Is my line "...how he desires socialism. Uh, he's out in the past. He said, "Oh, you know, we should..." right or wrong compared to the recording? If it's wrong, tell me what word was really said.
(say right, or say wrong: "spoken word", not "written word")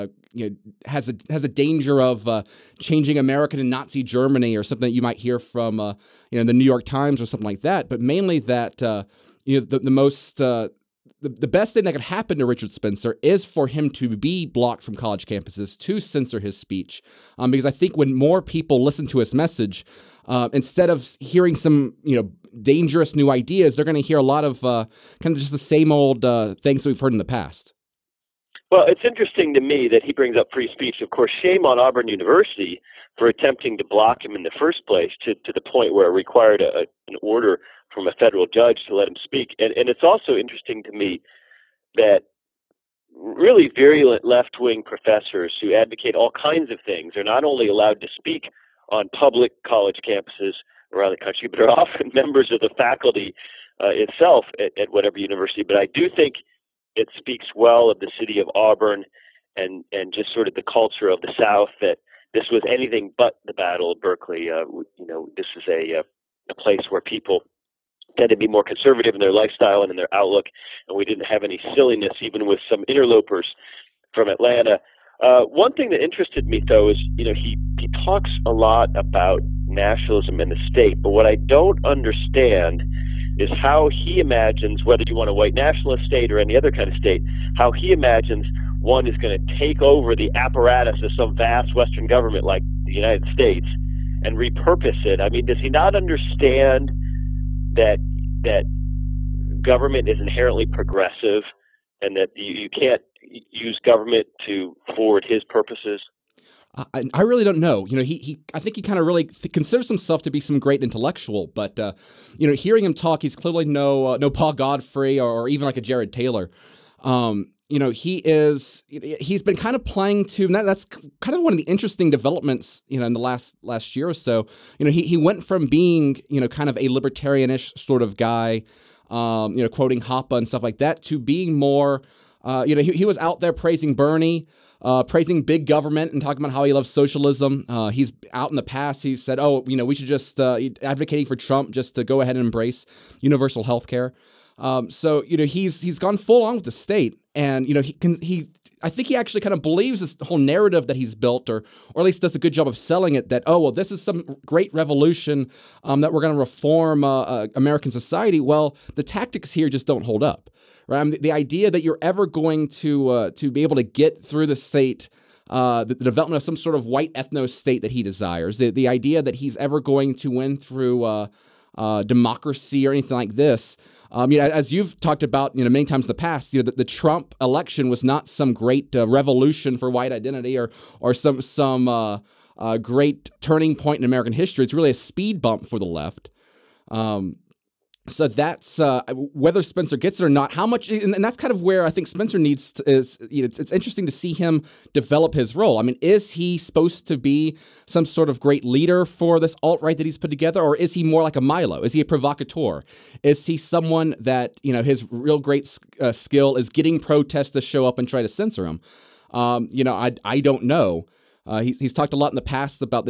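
wrong: "loves", not "desires".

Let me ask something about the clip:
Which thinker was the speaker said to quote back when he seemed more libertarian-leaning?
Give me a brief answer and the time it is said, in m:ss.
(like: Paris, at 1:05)
Hoppe, at 2:09.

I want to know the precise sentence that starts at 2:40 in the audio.
I um, mean, the idea that you're ever going to uh, to be able to get through the state.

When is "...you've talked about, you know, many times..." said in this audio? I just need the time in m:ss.
2:54.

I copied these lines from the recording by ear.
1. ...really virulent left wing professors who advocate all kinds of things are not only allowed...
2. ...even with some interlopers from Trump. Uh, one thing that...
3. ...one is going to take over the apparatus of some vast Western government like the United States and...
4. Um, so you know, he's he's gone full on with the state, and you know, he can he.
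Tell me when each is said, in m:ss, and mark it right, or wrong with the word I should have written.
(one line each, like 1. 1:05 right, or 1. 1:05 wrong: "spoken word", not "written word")
1. 0:43 right
2. 1:12 wrong: "Atlanta", not "Trump"
3. 1:28 right
4. 2:24 right.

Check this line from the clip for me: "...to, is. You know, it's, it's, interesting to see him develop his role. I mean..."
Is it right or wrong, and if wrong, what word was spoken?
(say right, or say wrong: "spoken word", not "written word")
right.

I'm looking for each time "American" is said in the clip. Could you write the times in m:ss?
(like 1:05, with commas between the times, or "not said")
0:03, 2:37, 3:04.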